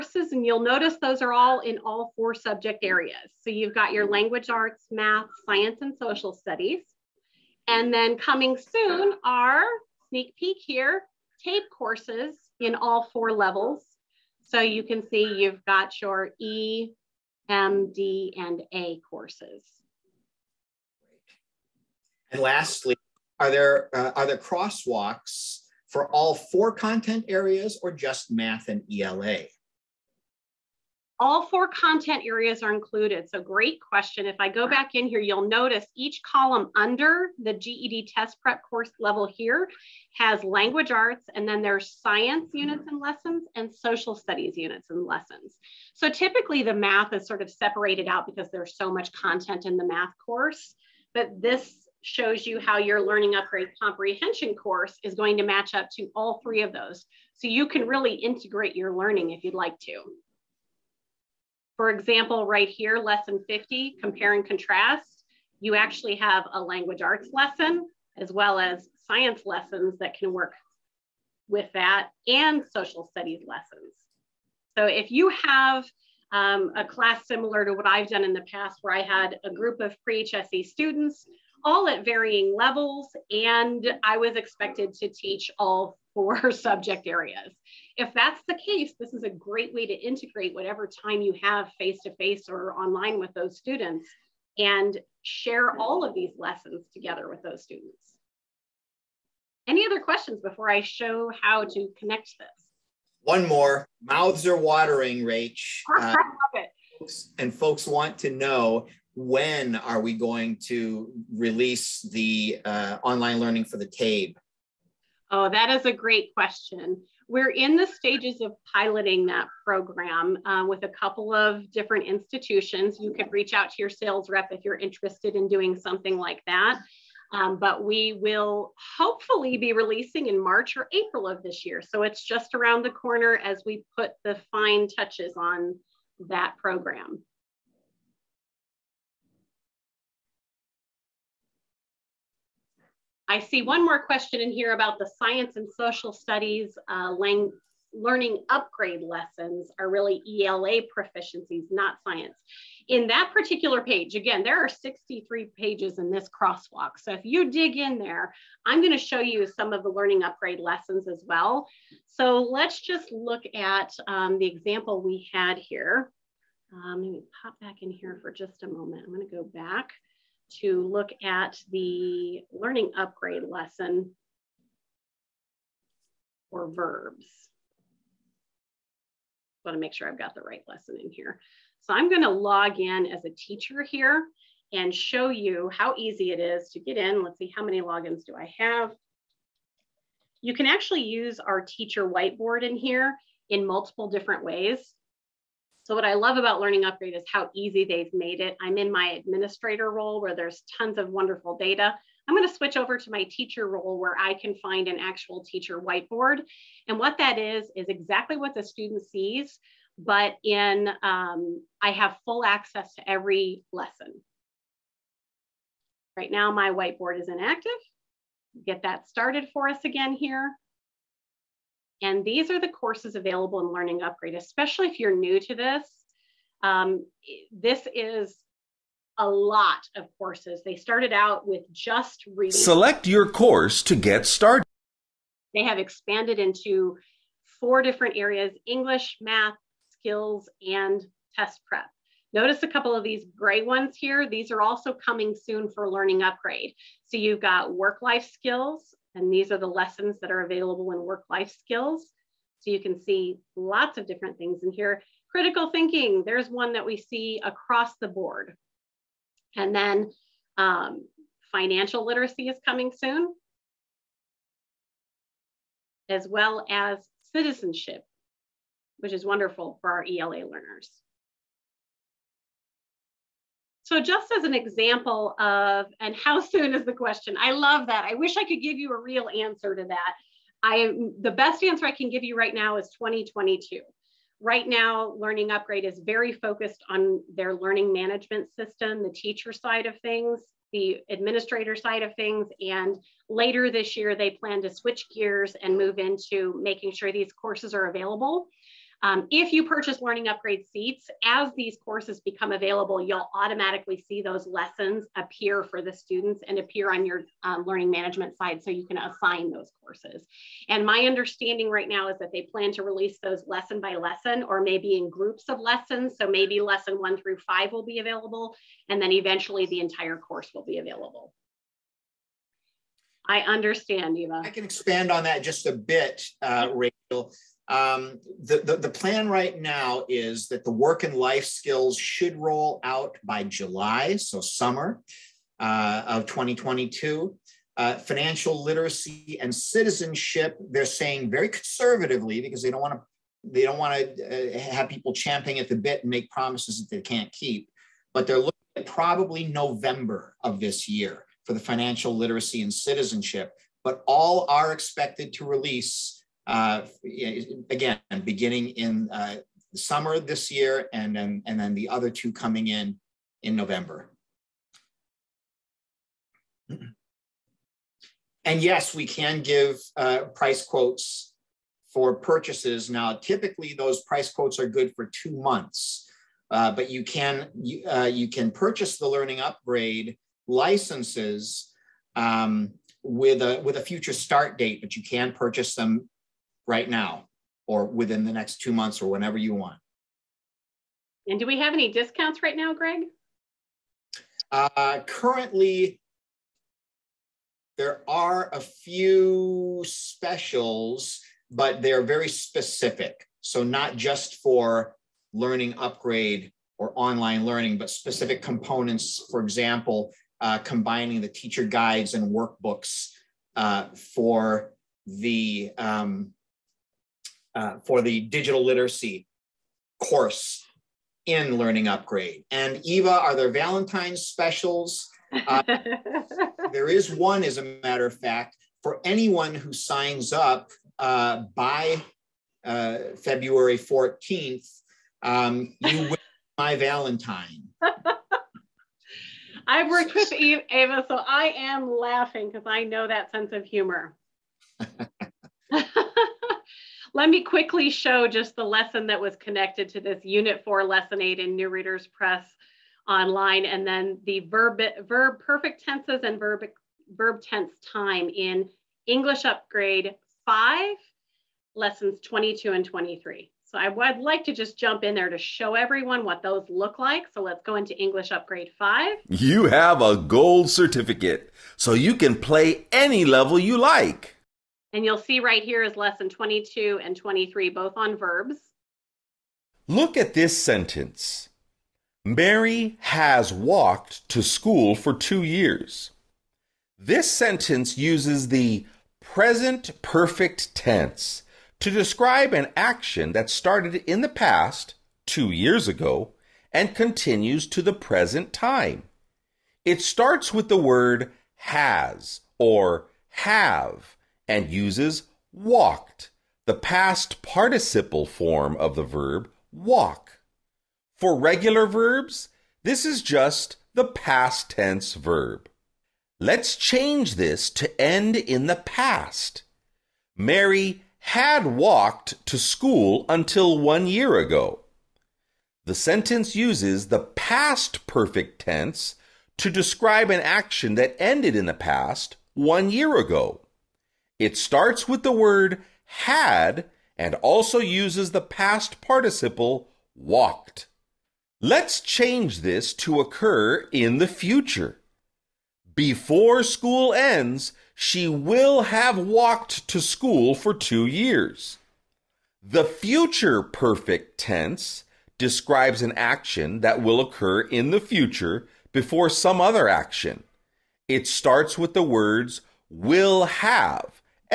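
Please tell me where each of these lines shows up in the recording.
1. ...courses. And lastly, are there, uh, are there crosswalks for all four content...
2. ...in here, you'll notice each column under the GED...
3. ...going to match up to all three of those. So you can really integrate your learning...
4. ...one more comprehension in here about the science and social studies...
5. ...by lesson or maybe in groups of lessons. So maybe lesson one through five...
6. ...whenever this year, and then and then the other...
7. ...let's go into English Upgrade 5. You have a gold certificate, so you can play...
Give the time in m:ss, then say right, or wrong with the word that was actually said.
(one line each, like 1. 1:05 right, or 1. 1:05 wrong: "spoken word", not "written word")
1. 0:19 right
2. 0:34 right
3. 0:55 right
4. 2:23 wrong: "question", not "comprehension"
5. 5:13 right
6. 5:59 wrong: "summer", not "whenever"
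7. 7:47 right.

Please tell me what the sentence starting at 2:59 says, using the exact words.
I want to make sure I've got the right lesson in here.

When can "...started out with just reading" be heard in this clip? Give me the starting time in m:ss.
3:50.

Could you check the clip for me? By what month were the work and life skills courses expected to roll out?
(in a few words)
July.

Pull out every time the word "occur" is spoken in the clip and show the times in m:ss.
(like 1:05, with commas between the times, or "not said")
9:03, 9:17.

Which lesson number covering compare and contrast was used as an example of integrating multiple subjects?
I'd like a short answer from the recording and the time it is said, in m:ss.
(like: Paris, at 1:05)
50, at 1:02.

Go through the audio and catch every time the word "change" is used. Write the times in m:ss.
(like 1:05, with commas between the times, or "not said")
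8:36, 9:02.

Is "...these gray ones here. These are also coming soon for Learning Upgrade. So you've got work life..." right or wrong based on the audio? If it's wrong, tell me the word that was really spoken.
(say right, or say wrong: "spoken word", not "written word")
right.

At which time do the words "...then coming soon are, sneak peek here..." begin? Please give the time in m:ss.
0:07.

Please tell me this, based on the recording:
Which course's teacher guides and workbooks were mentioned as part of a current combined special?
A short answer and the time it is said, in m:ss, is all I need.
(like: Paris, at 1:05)
Digital literacy, at 6:58.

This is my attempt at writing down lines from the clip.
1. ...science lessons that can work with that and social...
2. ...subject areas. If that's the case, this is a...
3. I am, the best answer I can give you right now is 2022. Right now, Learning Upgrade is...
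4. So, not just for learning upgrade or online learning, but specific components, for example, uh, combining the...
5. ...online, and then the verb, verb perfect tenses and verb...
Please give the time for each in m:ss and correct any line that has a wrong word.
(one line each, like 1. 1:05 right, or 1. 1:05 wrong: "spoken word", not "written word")
1. 1:09 right
2. 1:26 right
3. 4:40 right
4. 6:43 right
5. 7:33 right.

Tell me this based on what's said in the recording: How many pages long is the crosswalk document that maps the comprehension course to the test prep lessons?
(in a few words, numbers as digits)
63.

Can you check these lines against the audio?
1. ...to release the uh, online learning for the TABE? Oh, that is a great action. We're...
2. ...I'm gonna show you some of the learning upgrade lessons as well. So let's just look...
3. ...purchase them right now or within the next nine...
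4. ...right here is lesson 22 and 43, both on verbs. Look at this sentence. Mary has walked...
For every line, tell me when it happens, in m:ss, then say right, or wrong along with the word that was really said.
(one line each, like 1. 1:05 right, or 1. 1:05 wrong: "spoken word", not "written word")
1. 1:50 wrong: "question", not "action"
2. 2:38 right
3. 6:25 wrong: "two", not "nine"
4. 7:55 wrong: "23", not "43".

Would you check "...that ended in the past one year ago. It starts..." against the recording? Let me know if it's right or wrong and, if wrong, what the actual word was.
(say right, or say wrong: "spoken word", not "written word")
right.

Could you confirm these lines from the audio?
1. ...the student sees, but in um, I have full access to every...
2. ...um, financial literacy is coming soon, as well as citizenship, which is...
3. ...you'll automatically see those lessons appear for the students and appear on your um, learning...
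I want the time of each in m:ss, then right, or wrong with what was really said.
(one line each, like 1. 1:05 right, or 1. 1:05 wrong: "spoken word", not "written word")
1. 3:28 right
2. 4:20 right
3. 5:03 right.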